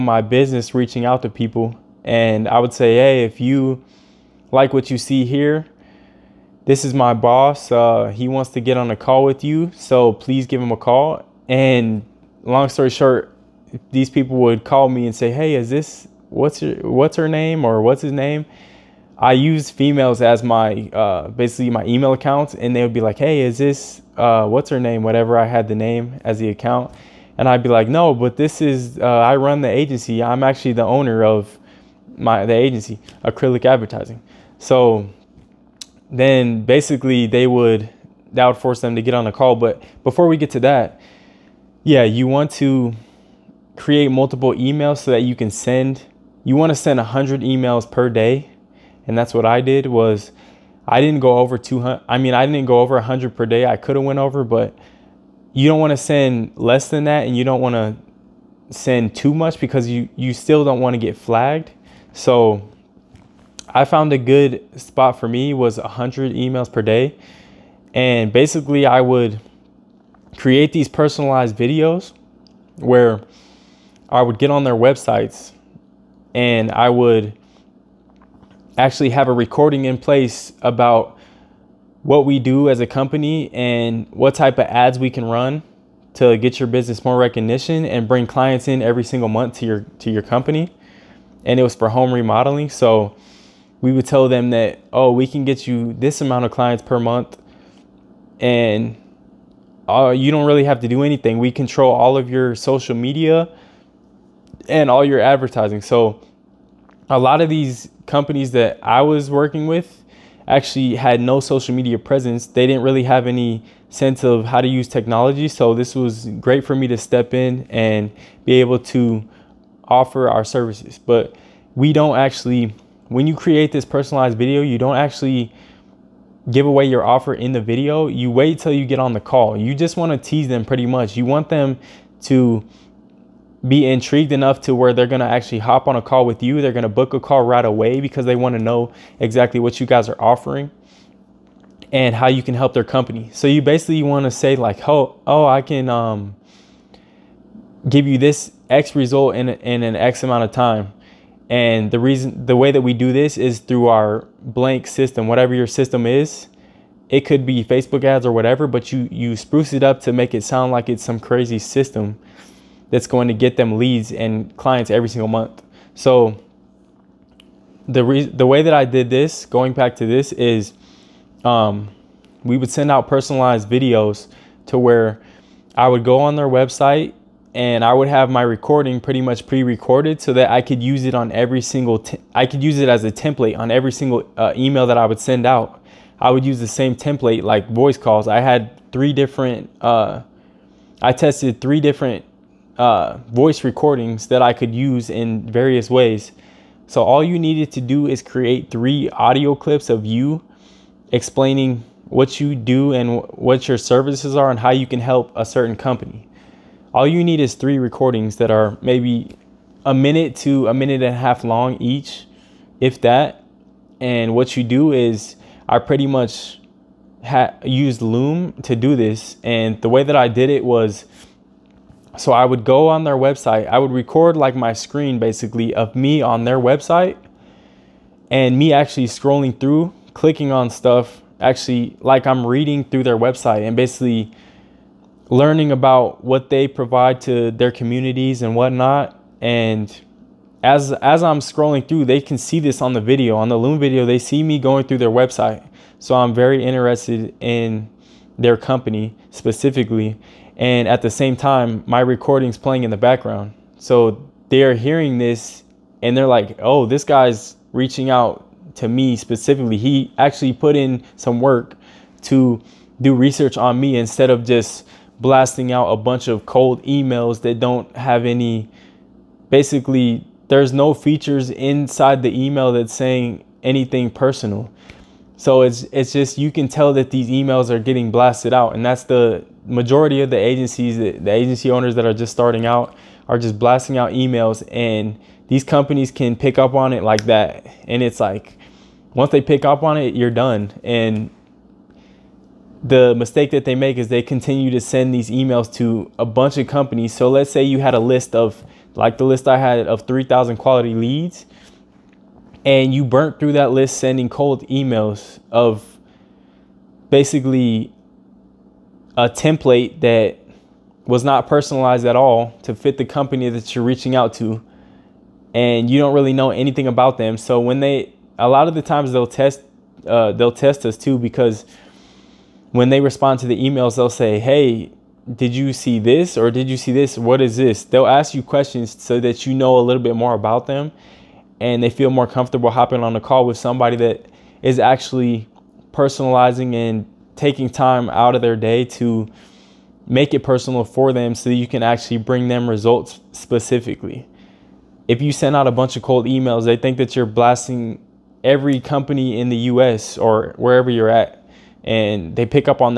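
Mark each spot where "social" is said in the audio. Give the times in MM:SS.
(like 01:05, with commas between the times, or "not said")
01:42, 01:51.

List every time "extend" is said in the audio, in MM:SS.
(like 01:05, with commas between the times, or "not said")
not said.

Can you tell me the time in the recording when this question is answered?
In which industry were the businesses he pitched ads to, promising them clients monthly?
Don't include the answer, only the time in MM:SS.
01:31.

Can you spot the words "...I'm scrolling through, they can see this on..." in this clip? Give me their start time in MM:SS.
04:01.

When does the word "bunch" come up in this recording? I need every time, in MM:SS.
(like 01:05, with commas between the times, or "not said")
04:25, 04:56, 05:45.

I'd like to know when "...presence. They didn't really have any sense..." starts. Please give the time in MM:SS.
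01:51.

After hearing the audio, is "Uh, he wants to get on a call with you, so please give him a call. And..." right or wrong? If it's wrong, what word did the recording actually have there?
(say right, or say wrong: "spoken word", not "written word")
right.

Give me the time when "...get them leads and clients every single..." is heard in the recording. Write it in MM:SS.
02:43.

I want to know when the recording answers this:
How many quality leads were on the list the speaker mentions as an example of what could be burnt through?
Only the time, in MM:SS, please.
05:00.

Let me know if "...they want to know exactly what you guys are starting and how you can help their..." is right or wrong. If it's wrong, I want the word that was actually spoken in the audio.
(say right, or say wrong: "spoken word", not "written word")
wrong: "offering", not "starting".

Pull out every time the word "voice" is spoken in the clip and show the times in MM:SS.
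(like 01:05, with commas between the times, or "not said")
03:07, 03:13.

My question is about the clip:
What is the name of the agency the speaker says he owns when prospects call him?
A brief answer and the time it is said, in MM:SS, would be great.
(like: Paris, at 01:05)
Acrylic Advertising, at 00:33.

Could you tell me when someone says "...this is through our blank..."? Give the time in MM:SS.
02:33.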